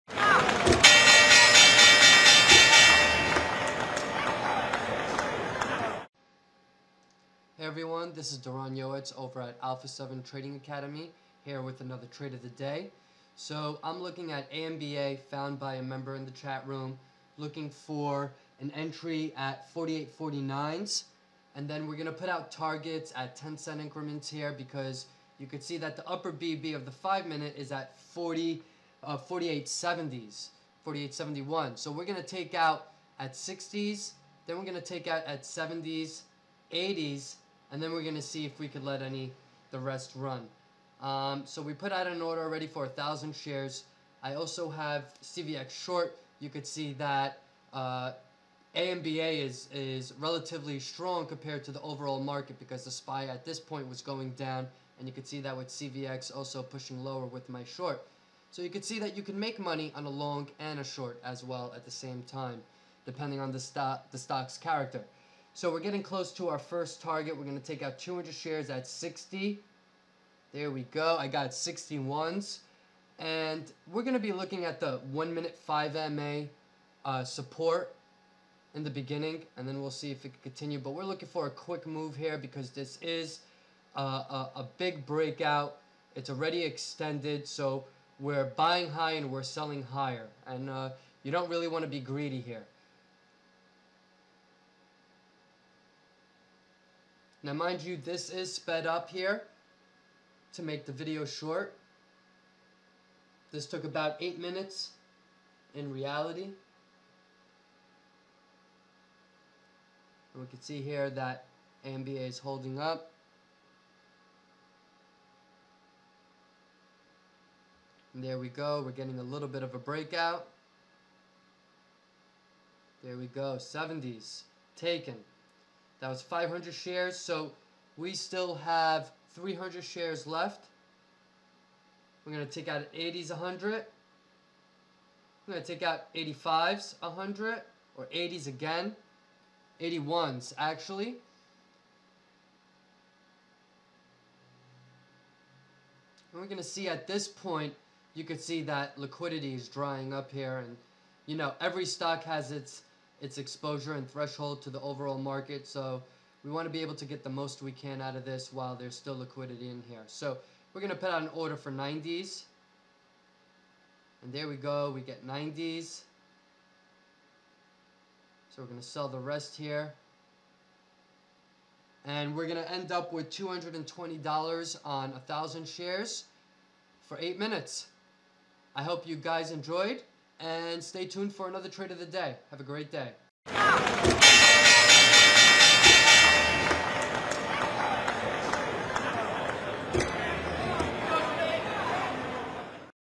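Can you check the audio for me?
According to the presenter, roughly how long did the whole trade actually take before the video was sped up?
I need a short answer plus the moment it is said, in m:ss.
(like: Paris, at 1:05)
8 minutes, at 1:43.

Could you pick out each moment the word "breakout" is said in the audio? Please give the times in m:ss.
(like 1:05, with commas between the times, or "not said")
1:25, 1:59.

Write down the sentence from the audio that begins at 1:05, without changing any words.
So we're getting close to our first target.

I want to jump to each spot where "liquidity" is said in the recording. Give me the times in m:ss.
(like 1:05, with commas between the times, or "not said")
2:28, 2:39.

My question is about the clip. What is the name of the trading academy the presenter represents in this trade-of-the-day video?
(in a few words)
Alpha 7 Trading Academy.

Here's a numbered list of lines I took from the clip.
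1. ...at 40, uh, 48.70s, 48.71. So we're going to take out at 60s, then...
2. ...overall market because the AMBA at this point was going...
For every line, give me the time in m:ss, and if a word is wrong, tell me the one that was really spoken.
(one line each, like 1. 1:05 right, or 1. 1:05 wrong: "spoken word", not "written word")
1. 0:27 right
2. 0:51 wrong: "SPY", not "AMBA".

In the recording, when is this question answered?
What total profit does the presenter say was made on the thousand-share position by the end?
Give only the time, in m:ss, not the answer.
2:53.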